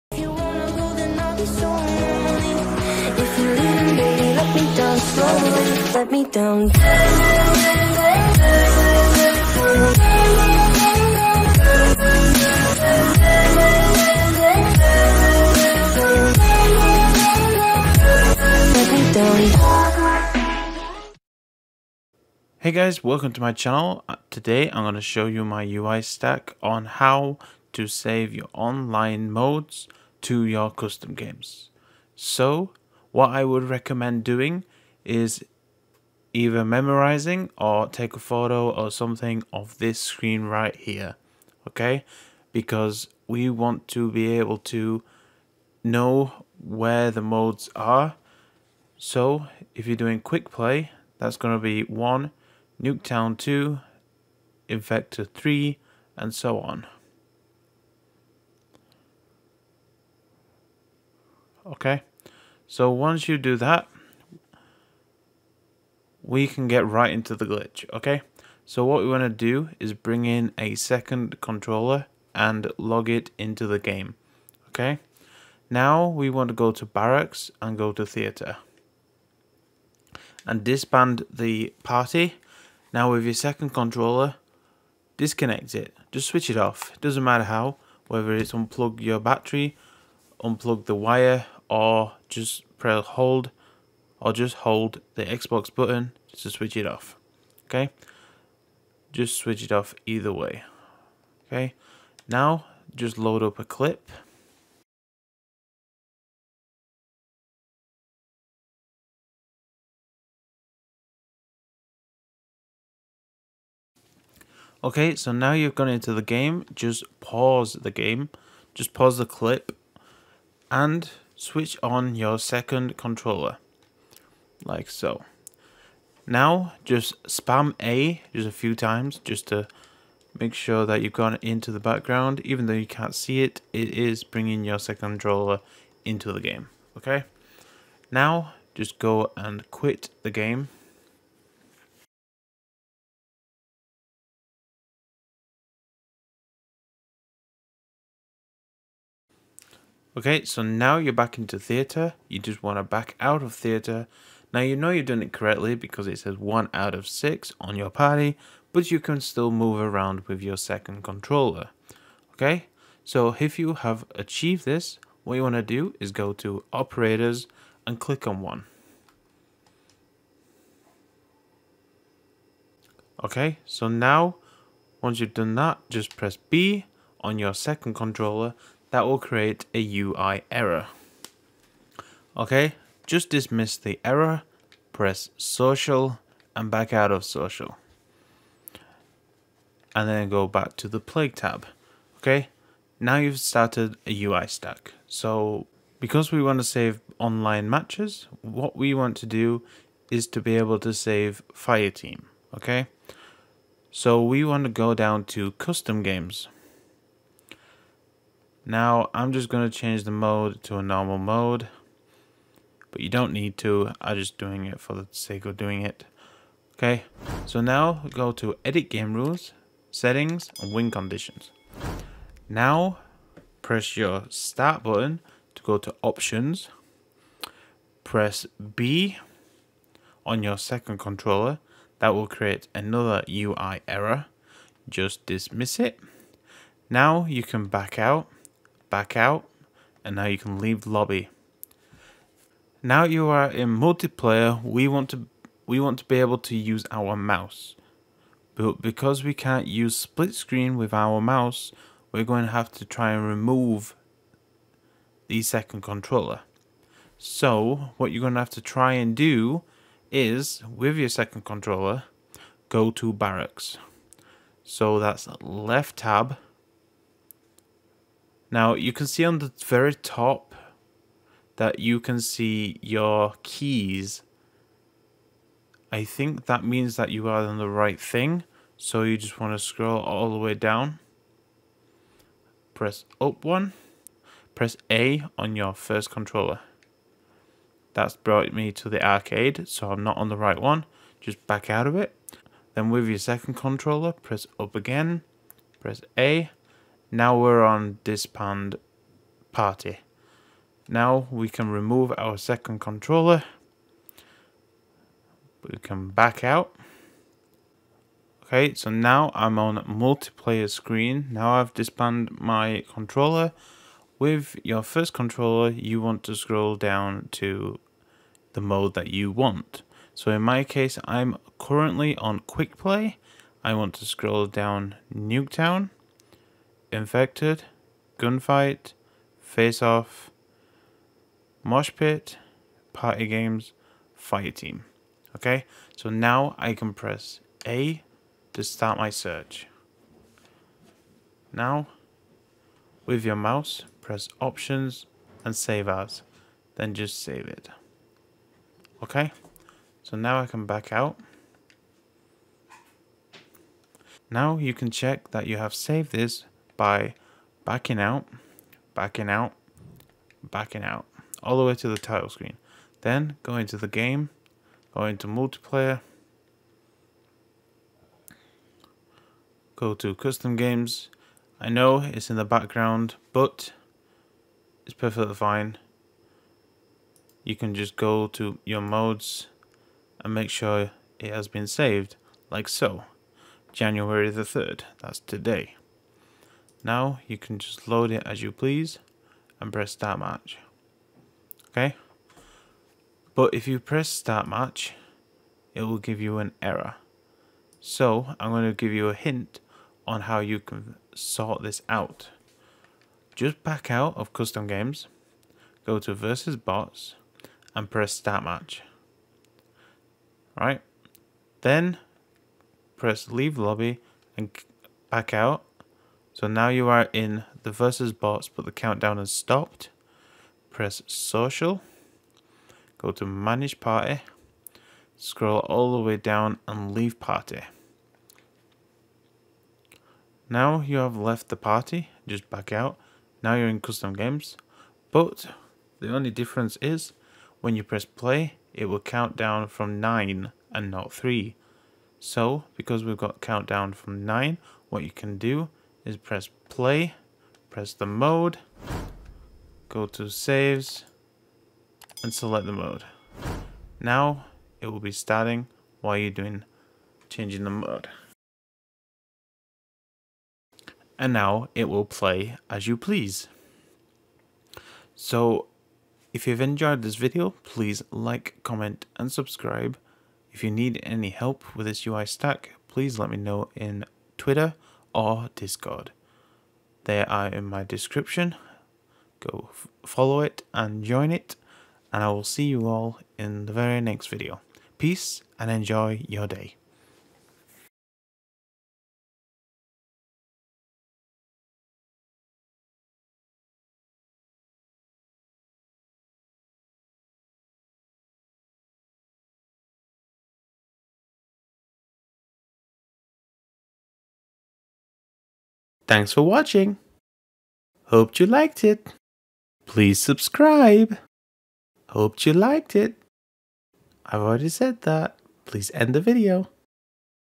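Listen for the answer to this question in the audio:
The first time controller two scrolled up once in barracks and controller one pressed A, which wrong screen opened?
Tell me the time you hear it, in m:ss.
4:49.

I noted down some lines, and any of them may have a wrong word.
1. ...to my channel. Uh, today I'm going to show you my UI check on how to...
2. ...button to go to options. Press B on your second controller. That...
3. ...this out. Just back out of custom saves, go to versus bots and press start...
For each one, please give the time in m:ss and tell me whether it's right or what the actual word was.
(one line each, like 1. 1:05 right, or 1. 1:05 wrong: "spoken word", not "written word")
1. 0:23 wrong: "stack", not "check"
2. 3:44 right
3. 6:41 wrong: "games", not "saves".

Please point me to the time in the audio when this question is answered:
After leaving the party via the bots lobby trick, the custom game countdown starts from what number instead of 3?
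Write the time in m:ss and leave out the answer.
7:18.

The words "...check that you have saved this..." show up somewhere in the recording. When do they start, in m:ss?
5:54.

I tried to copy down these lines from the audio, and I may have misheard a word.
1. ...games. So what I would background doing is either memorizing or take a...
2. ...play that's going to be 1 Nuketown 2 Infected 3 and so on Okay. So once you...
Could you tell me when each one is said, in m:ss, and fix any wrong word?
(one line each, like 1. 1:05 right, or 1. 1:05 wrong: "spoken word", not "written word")
1. 0:31 wrong: "recommend", not "background"
2. 0:50 right.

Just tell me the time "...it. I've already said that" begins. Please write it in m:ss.
8:32.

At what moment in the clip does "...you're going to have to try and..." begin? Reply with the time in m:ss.
4:18.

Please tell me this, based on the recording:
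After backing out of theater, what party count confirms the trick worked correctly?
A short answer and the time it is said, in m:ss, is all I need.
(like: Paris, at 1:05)
1 out of 6, at 2:36.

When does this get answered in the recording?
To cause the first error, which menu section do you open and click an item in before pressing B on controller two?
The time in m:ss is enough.
2:46.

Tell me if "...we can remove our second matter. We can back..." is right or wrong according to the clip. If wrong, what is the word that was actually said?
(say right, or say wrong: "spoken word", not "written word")
wrong: "controller", not "matter".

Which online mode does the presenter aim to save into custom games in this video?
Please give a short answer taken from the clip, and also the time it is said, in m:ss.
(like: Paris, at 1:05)
Fire Team, at 3:21.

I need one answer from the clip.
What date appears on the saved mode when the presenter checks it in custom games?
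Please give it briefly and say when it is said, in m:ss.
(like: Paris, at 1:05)
January 3rd, at 6:23.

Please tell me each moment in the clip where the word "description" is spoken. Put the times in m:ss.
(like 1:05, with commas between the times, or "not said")
7:57.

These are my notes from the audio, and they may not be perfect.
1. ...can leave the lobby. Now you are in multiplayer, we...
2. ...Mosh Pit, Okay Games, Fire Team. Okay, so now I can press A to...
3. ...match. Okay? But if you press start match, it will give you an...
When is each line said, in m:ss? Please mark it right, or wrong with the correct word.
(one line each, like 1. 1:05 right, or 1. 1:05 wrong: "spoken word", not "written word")
1. 4:00 right
2. 5:31 wrong: "Party", not "Okay"
3. 6:30 right.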